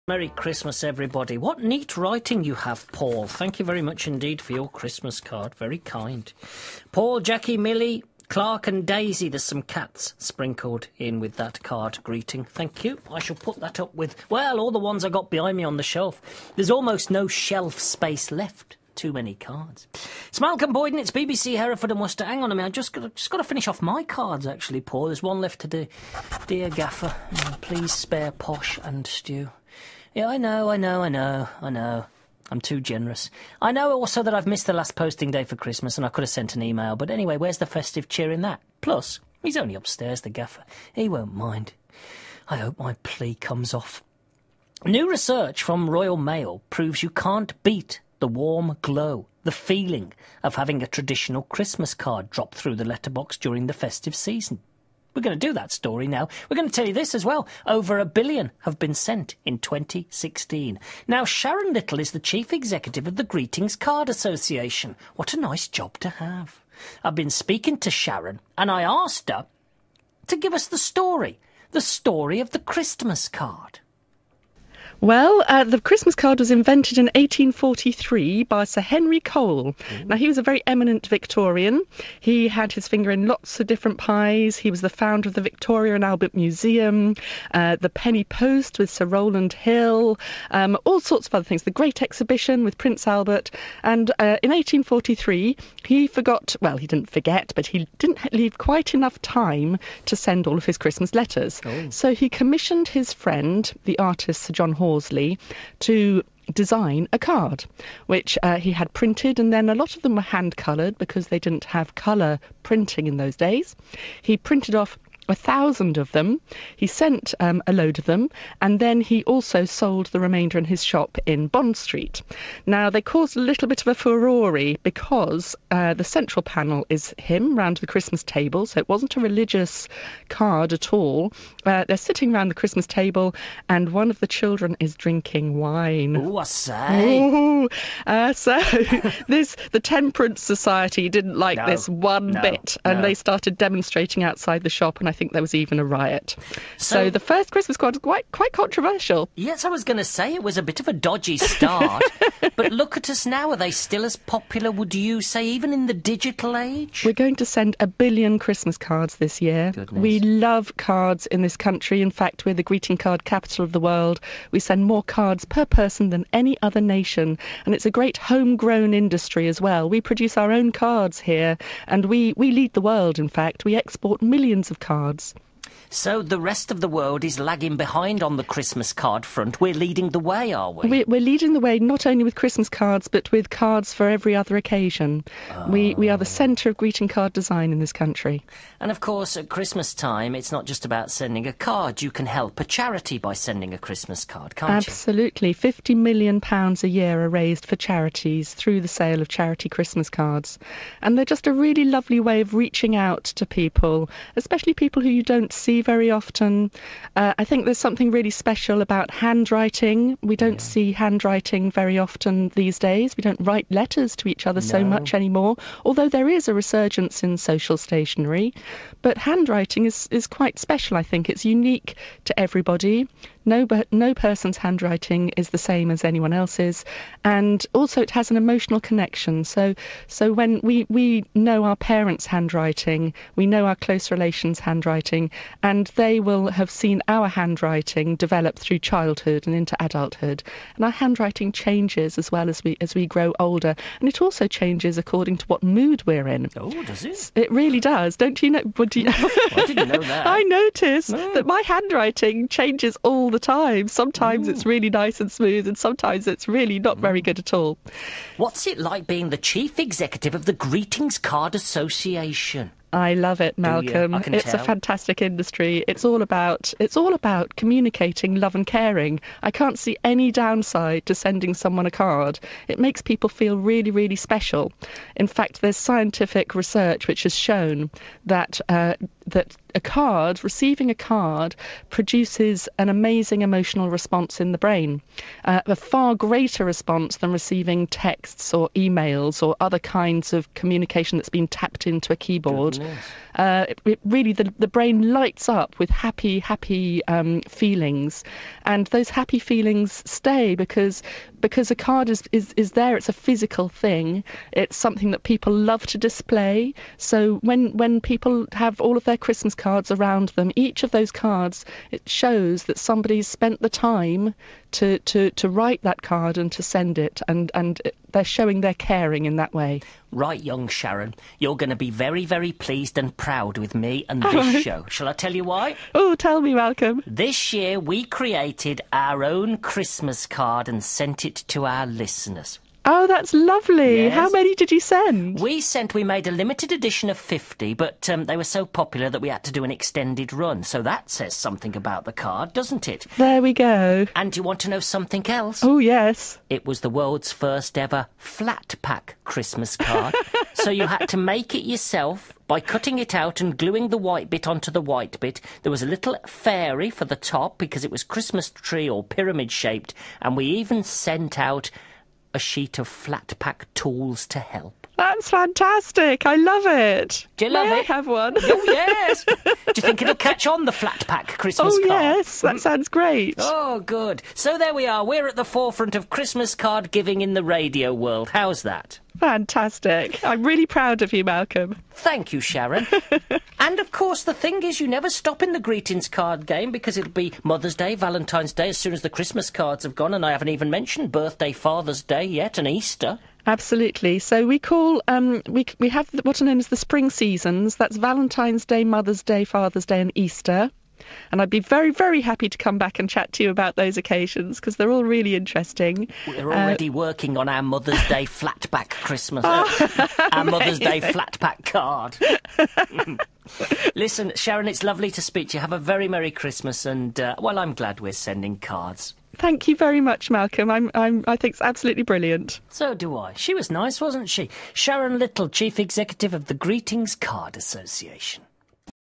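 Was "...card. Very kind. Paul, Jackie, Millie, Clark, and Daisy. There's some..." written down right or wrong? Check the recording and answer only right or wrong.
right.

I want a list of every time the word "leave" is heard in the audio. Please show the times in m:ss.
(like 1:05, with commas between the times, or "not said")
1:38.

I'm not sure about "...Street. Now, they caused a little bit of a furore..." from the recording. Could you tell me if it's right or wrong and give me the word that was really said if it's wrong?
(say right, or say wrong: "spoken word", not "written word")
right.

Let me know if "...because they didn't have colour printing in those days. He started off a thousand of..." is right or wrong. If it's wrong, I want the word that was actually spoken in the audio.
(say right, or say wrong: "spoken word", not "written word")
wrong: "printed", not "started".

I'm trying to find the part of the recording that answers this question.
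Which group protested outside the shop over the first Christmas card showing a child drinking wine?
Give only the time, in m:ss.
2:19.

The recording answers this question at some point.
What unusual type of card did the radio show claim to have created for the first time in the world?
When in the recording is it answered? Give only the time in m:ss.
5:48.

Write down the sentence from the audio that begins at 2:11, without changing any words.
Uh, they're sitting round the Christmas table, and one of the children is drinking wine.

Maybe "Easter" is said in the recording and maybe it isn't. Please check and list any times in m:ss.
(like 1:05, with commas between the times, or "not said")
6:32, 6:40.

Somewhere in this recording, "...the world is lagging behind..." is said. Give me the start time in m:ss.
2:56.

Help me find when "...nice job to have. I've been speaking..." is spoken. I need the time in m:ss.
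1:05.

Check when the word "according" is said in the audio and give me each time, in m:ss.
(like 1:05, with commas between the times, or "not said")
4:04.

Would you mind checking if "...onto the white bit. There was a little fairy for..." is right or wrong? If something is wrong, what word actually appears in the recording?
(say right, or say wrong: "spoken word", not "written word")
right.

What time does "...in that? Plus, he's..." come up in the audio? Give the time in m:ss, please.
0:38.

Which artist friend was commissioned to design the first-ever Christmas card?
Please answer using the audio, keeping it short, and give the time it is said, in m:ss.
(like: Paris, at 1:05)
Sir John Hall Horsley, at 1:44.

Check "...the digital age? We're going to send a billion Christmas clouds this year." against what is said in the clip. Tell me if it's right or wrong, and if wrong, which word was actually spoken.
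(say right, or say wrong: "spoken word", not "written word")
wrong: "cards", not "clouds".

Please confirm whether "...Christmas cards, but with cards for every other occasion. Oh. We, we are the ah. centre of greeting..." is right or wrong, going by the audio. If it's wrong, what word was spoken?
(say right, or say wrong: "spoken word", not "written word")
right.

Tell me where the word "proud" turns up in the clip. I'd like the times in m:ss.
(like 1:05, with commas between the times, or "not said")
5:23, 6:20.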